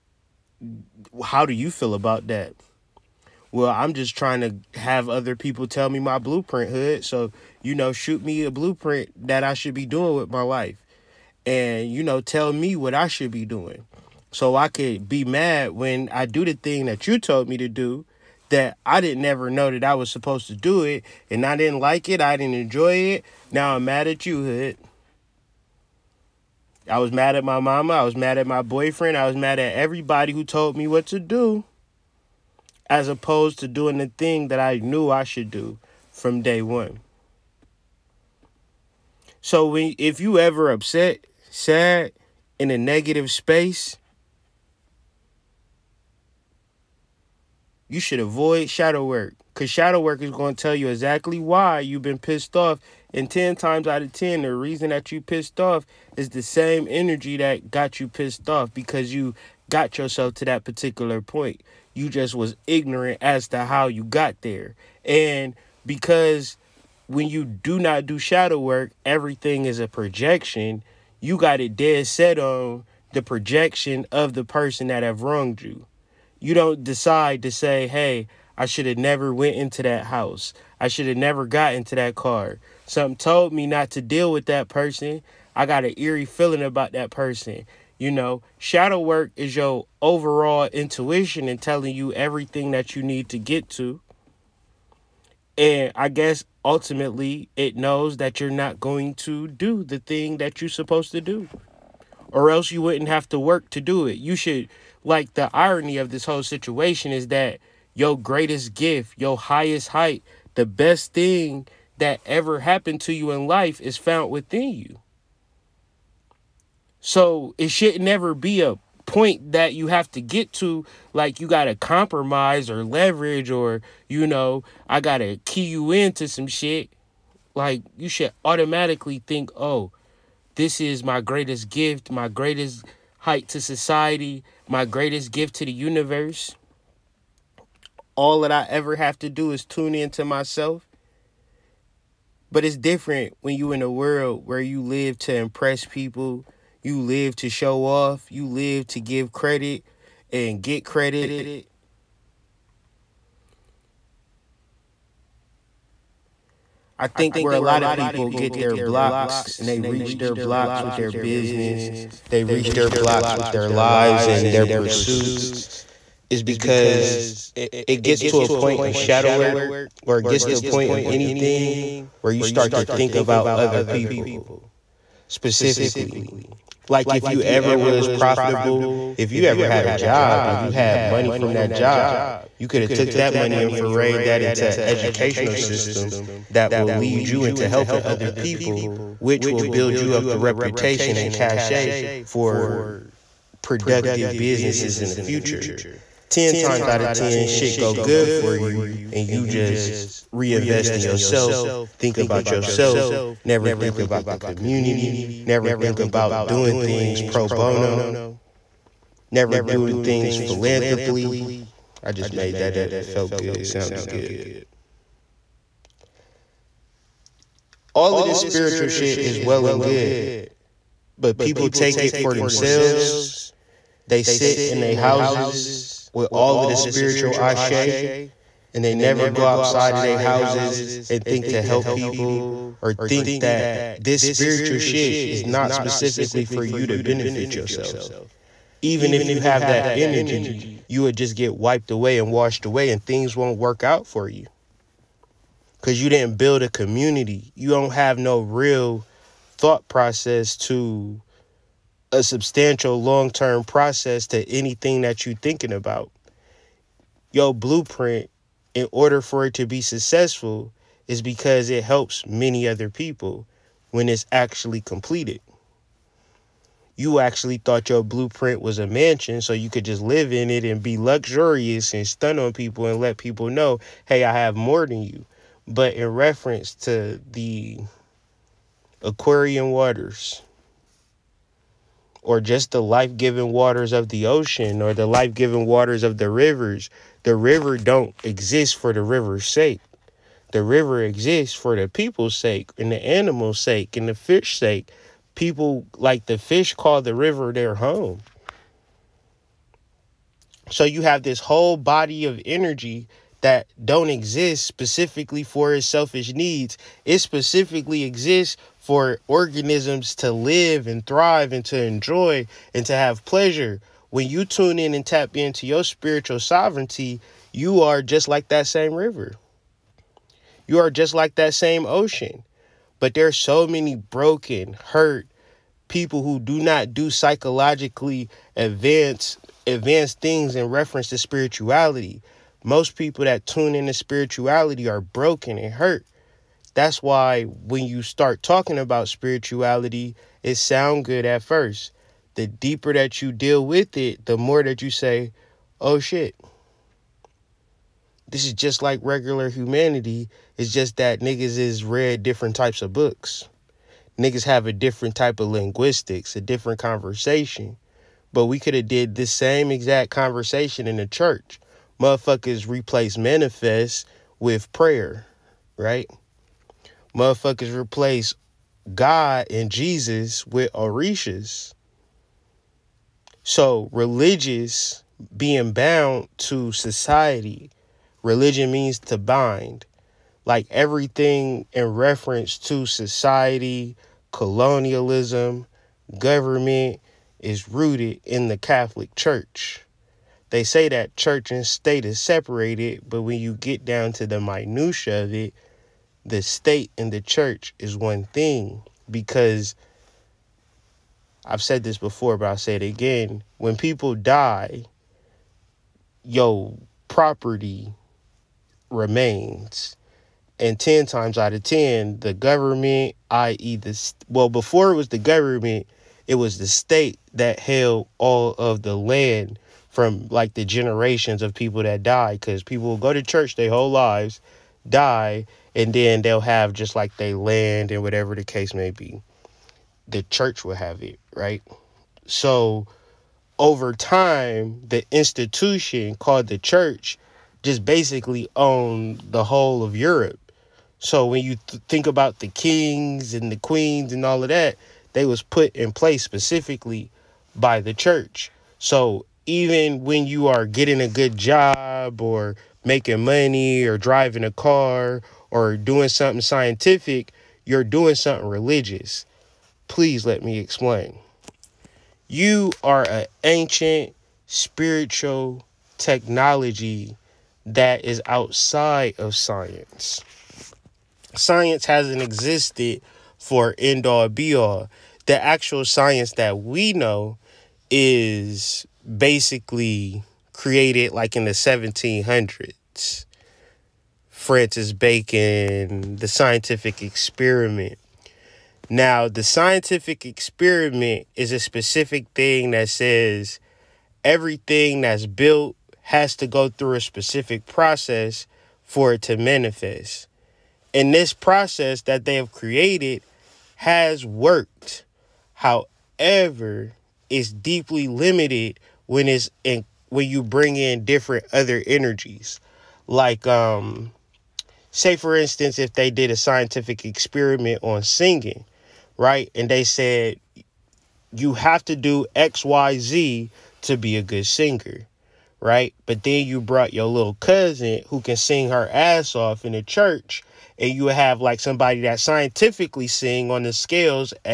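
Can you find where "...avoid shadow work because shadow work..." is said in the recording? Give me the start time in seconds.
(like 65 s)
48 s.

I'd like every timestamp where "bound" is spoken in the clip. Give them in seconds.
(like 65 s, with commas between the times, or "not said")
375 s.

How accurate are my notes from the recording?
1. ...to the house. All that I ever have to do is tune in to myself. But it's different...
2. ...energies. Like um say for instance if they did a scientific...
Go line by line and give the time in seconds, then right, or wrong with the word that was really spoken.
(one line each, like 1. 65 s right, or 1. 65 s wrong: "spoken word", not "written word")
1. 135 s wrong: "universe", not "house"
2. 511 s right.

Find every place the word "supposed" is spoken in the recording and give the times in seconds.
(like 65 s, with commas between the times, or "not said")
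20 s, 100 s.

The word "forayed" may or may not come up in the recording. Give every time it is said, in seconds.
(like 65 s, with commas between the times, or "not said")
183 s.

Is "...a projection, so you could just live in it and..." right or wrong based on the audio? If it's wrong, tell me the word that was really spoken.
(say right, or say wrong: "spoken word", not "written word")
wrong: "mansion", not "projection".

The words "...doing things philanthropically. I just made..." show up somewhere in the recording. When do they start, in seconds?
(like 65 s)
209 s.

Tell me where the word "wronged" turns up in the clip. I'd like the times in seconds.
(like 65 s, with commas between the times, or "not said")
75 s.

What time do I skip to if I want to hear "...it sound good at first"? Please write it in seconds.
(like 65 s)
340 s.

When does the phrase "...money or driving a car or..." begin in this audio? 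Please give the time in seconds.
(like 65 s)
453 s.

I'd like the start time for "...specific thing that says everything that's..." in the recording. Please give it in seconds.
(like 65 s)
491 s.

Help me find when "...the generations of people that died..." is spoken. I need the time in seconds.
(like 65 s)
420 s.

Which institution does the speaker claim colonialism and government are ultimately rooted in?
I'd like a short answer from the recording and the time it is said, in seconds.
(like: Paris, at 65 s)
the Catholic Church, at 388 s.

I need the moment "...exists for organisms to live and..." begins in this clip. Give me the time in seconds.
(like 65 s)
308 s.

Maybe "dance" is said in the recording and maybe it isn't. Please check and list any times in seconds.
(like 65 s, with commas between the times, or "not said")
not said.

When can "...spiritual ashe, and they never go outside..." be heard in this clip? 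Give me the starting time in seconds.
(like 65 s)
226 s.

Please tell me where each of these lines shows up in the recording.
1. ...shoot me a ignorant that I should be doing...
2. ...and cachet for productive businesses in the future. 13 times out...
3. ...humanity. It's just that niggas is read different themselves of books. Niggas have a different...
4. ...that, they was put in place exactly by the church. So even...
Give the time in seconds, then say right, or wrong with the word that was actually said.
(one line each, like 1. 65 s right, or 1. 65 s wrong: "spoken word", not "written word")
1. 7 s wrong: "blueprint", not "ignorant"
2. 191 s wrong: "10", not "13"
3. 349 s wrong: "types", not "themselves"
4. 444 s wrong: "specifically", not "exactly".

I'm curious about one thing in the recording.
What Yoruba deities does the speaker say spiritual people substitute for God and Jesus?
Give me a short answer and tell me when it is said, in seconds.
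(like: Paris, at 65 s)
orishas, at 370 s.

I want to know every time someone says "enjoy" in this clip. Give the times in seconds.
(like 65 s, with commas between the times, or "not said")
22 s, 311 s.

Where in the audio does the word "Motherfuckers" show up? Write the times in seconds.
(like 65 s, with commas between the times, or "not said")
362 s, 367 s.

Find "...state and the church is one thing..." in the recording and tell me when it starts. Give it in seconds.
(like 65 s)
396 s.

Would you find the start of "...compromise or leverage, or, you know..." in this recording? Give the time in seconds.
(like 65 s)
121 s.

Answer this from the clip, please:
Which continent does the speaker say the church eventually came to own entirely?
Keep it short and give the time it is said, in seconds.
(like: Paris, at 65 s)
Europe, at 439 s.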